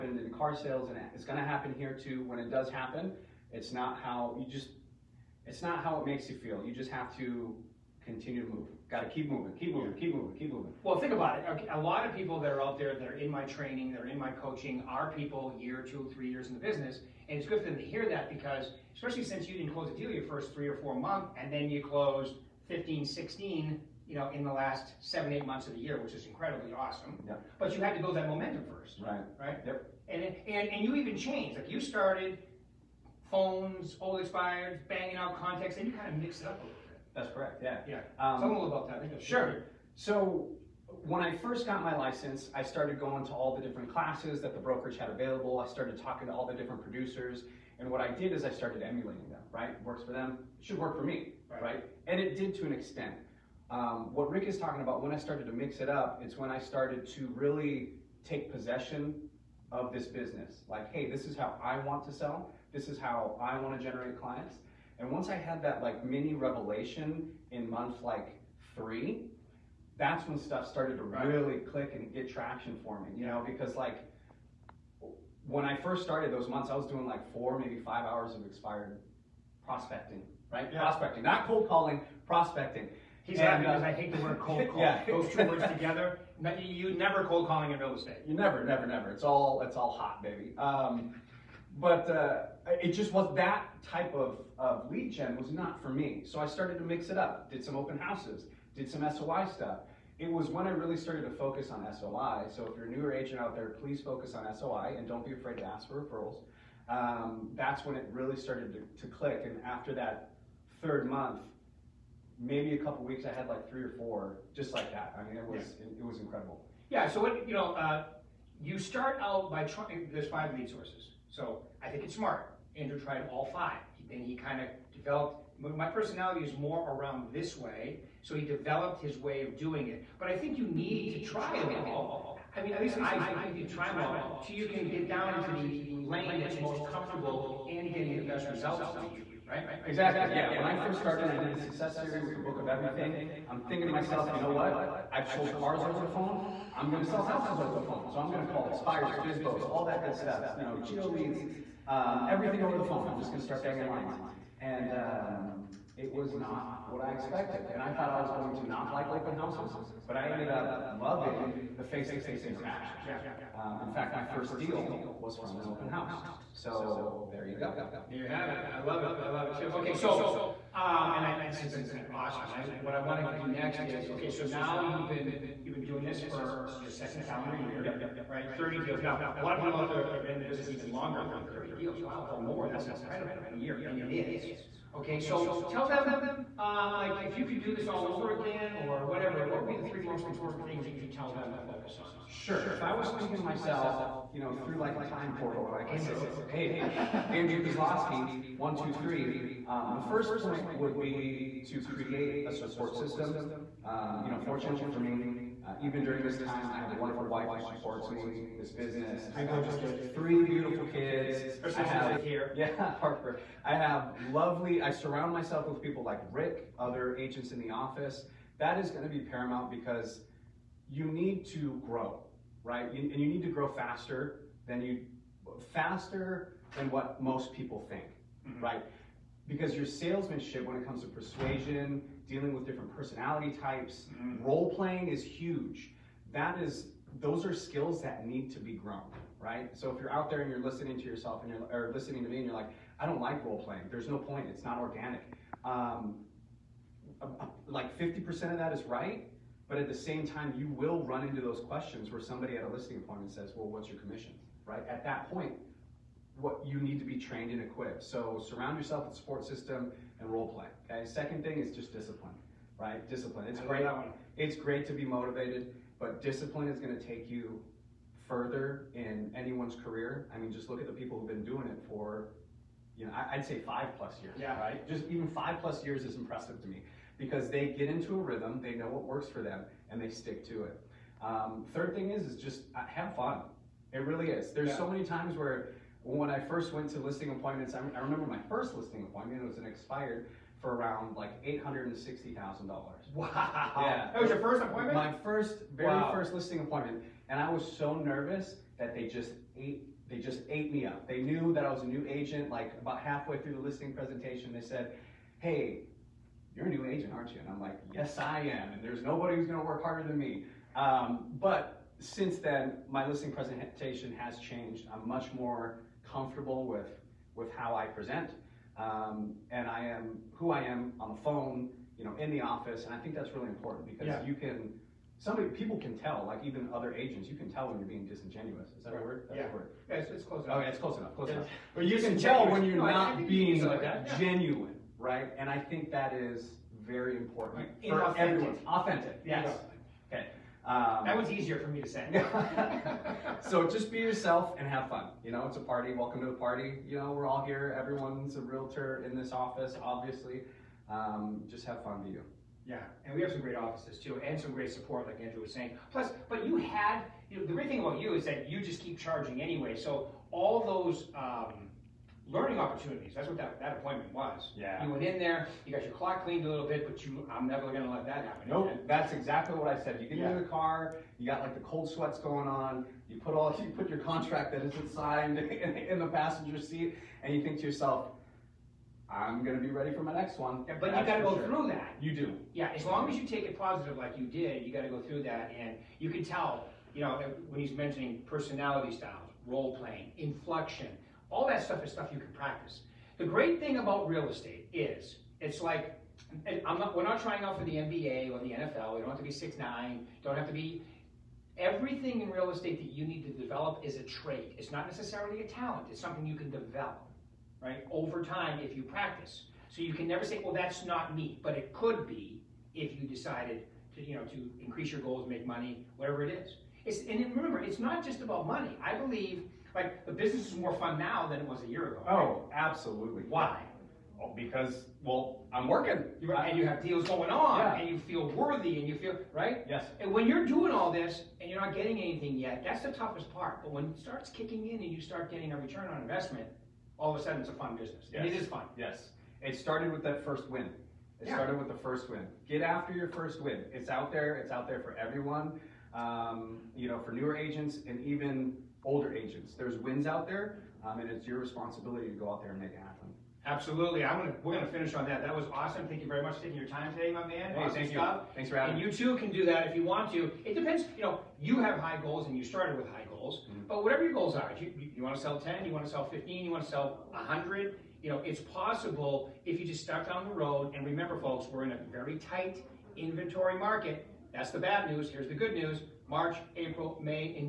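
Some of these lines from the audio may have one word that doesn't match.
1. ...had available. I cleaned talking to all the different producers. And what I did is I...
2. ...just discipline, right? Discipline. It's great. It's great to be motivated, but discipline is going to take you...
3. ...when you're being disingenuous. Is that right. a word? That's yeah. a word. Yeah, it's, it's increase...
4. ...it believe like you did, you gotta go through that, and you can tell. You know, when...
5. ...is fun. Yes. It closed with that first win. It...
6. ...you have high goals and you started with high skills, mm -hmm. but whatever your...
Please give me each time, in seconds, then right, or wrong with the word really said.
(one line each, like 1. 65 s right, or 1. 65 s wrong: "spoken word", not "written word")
1. 44 s wrong: "started", not "cleaned"
2. 261 s right
3. 327 s wrong: "close", not "increase"
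4. 383 s wrong: "positive", not "believe"
5. 438 s wrong: "started", not "closed"
6. 461 s wrong: "goals", not "skills".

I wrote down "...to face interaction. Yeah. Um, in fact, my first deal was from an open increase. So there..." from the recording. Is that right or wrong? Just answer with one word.
wrong.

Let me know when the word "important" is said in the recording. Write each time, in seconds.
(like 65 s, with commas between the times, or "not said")
190 s, 323 s, 337 s.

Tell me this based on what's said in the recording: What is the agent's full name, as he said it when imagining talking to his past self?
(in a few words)
Andrew Kosloske.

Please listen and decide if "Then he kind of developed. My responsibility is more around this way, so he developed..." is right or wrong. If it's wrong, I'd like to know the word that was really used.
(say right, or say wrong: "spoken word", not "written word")
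wrong: "personality", not "responsibility".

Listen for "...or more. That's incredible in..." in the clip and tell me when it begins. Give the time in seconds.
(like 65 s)
182 s.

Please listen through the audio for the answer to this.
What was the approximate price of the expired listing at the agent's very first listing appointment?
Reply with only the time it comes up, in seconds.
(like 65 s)
291 s.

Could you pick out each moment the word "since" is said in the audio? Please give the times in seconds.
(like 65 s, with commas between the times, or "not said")
19 s, 311 s.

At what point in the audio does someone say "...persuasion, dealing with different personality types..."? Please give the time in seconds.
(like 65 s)
231 s.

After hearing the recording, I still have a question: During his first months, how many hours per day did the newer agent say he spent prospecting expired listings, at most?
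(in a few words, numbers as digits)
5.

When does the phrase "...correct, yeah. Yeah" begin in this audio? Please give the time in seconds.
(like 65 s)
37 s.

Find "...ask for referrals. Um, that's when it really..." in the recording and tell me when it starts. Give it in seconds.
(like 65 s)
105 s.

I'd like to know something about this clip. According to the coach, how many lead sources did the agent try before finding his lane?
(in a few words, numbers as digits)
5.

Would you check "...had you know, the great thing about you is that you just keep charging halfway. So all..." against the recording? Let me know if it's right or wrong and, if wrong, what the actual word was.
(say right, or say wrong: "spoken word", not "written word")
wrong: "anyway", not "halfway".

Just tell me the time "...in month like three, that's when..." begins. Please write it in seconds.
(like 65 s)
67 s.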